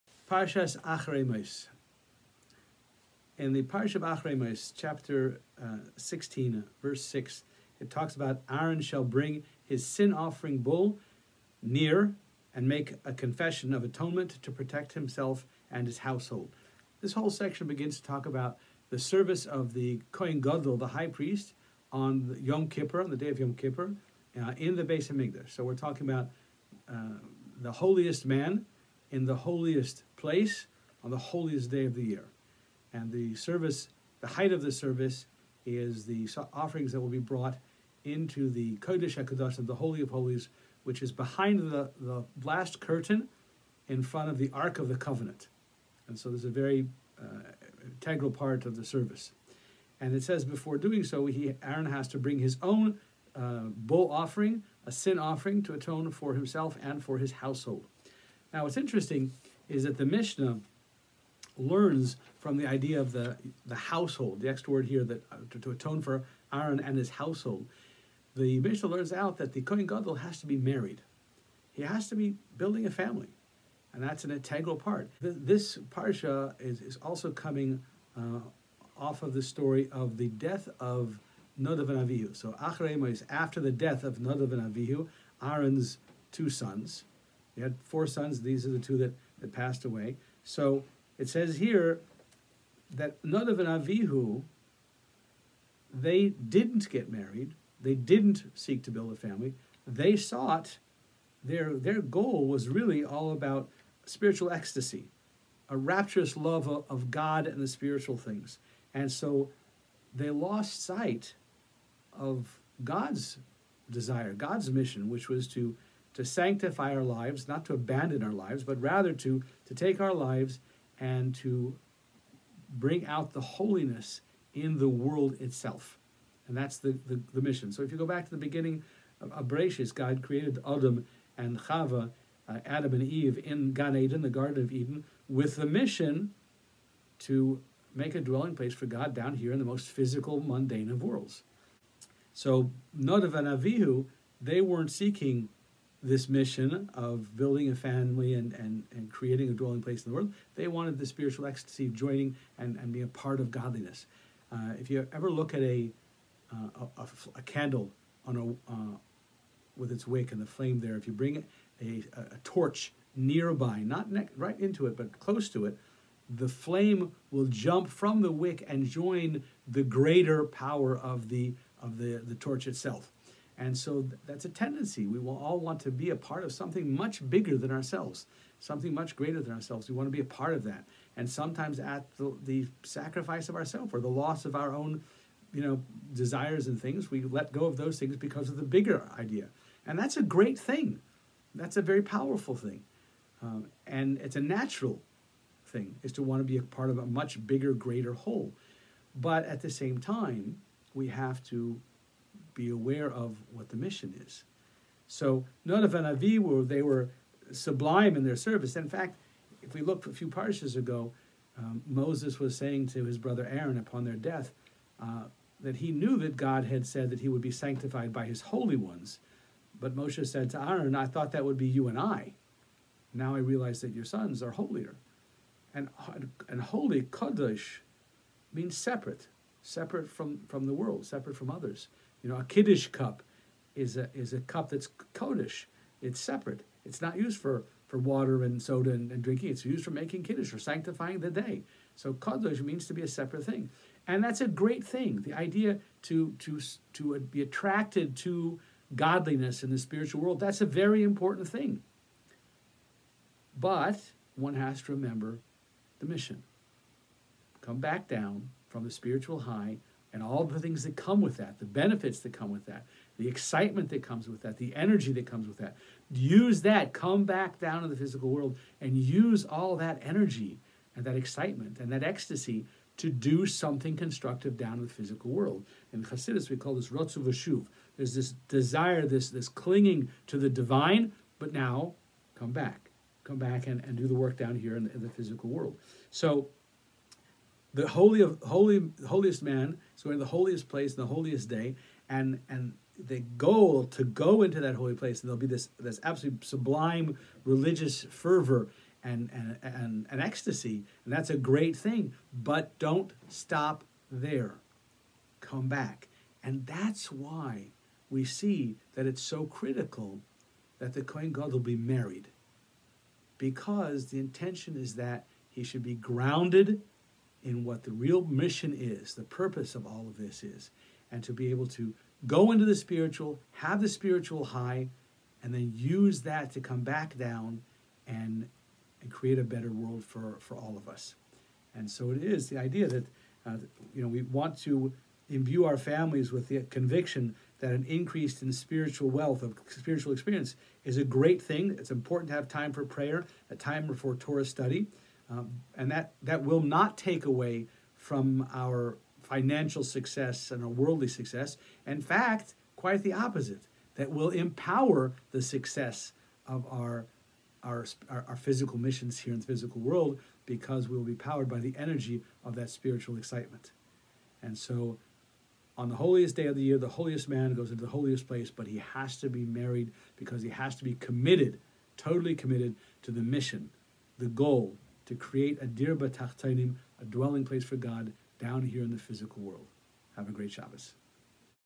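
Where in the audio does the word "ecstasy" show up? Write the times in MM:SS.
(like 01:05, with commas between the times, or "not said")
01:44, 02:31, 04:32, 05:00.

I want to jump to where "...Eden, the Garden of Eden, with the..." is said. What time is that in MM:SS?
02:13.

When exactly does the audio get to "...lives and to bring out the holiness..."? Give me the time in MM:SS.
02:00.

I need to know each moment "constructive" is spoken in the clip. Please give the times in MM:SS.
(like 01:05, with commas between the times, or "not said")
04:33.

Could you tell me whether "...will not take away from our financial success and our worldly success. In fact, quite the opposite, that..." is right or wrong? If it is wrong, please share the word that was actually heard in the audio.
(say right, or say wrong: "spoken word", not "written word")
right.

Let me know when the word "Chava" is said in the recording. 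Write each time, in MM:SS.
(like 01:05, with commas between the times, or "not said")
02:11.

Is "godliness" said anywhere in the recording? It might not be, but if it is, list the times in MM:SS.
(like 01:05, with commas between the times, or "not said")
02:33, 04:08.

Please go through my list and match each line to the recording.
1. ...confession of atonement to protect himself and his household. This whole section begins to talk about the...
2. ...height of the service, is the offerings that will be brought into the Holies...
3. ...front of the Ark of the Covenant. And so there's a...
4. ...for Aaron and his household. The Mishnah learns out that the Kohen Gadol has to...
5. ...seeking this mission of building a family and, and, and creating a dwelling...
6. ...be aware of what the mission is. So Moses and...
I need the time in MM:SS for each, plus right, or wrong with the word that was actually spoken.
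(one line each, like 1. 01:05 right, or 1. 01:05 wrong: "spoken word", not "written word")
1. 00:13 right
2. 00:34 wrong: "Kodesh", not "Holies"
3. 00:44 right
4. 01:06 right
5. 02:24 right
6. 03:22 wrong: "Nadav", not "Moses".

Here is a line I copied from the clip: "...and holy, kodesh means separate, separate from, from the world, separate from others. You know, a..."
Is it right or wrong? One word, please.
right.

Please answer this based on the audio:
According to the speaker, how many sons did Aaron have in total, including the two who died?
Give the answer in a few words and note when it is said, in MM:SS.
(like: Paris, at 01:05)
4, at 01:27.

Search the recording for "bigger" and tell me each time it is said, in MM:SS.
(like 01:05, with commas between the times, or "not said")
02:57, 03:08, 03:17.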